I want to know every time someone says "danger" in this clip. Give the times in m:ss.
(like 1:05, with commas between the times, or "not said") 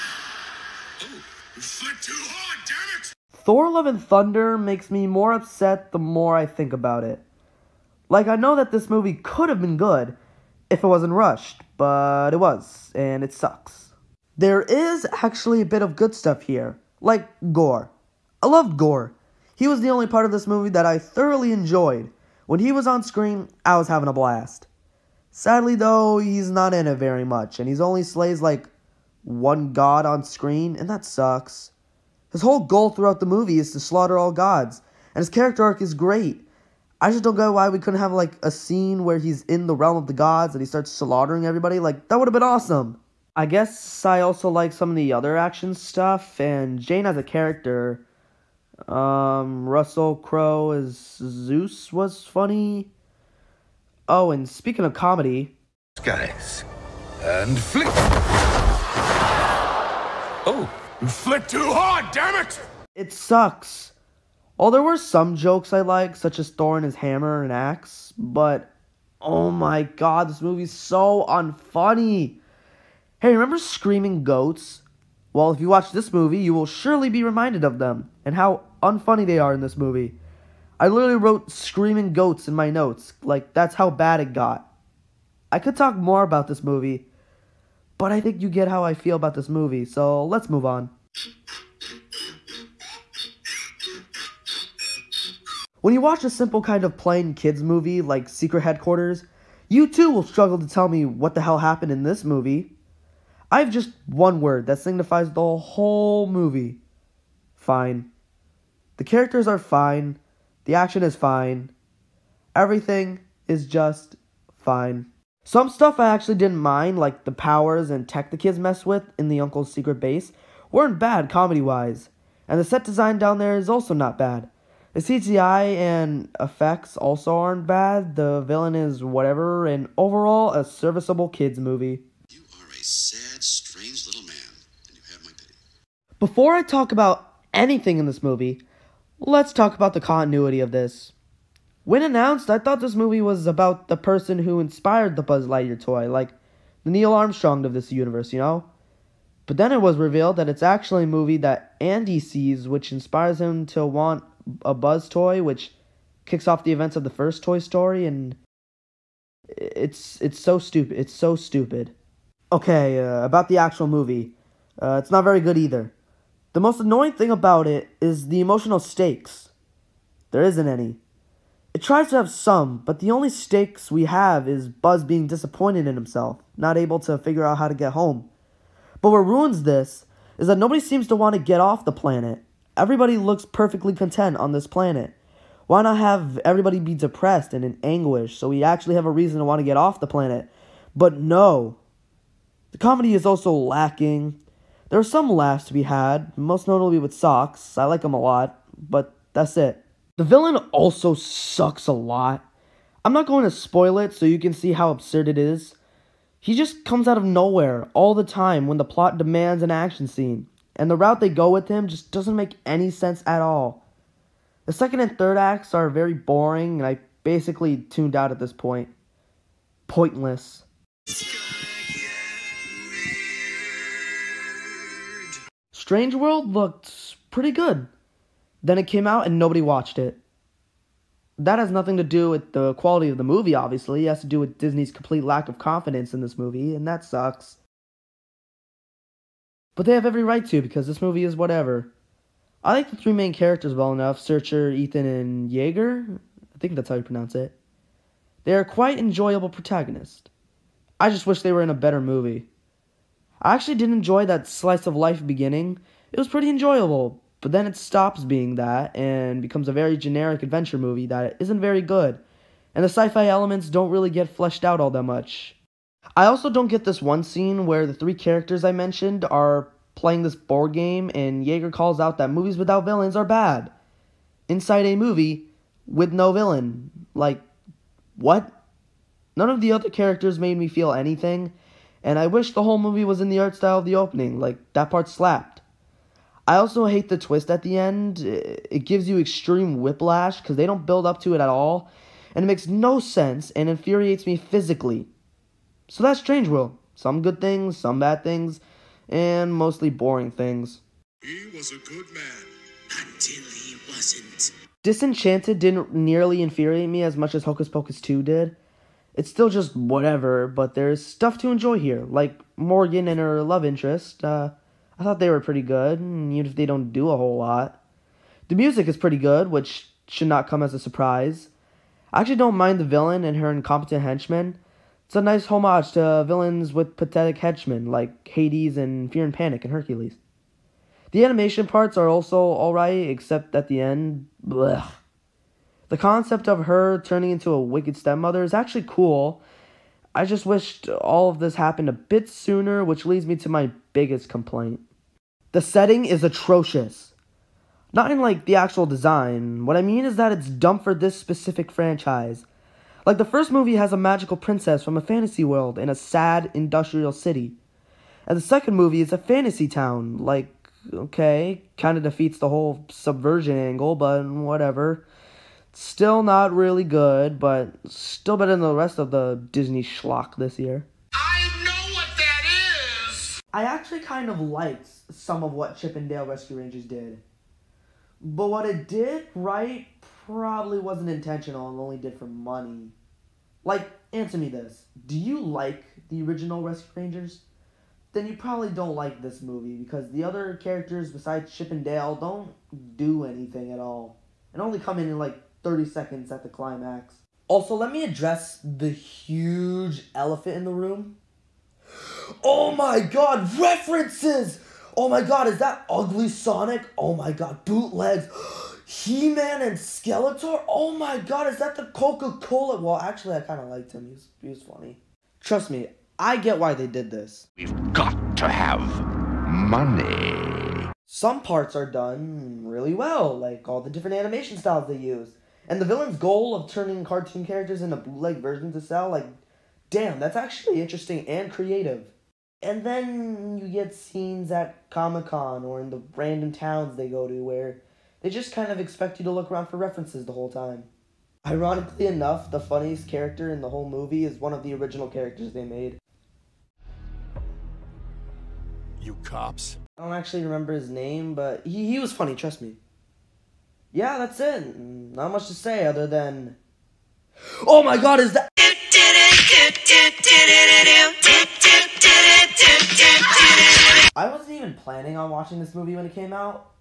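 not said.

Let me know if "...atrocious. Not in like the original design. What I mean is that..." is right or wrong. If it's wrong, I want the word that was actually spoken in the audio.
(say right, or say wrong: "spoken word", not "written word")
wrong: "actual", not "original".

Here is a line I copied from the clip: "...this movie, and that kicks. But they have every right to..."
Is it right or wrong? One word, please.
wrong.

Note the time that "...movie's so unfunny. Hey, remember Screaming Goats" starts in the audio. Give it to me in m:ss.
1:10.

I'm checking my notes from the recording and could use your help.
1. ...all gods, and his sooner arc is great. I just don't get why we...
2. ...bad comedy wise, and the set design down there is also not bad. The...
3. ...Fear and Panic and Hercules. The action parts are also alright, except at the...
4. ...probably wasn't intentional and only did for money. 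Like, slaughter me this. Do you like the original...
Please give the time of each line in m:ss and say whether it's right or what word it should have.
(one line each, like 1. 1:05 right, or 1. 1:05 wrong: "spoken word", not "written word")
1. 0:34 wrong: "character", not "sooner"
2. 2:00 right
3. 5:29 wrong: "animation", not "action"
4. 6:20 wrong: "answer", not "slaughter".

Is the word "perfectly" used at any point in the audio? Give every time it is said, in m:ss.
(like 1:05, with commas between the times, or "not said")
3:03.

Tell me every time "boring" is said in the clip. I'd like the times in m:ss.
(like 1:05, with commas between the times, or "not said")
3:36, 4:59.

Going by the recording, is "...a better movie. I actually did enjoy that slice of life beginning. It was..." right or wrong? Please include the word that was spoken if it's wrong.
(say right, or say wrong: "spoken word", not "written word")
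right.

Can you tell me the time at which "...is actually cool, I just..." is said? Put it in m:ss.
5:38.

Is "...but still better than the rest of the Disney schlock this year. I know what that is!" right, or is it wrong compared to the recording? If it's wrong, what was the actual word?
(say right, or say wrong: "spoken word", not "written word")
right.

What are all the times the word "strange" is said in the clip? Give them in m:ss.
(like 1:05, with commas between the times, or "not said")
2:13, 3:45, 4:56.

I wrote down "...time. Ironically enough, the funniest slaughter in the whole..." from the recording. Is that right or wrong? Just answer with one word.
wrong.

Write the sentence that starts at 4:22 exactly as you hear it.
And the sci fi elements don't really get fleshed out all that much.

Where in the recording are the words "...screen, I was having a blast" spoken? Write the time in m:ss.
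0:23.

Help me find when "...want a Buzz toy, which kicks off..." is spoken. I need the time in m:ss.
2:33.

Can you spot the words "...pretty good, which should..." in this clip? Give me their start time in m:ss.
5:18.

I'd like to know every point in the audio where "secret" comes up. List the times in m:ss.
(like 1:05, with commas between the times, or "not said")
1:38, 1:59.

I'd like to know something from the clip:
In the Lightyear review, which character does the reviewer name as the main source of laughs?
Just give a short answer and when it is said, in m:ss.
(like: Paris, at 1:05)
Socks, at 3:17.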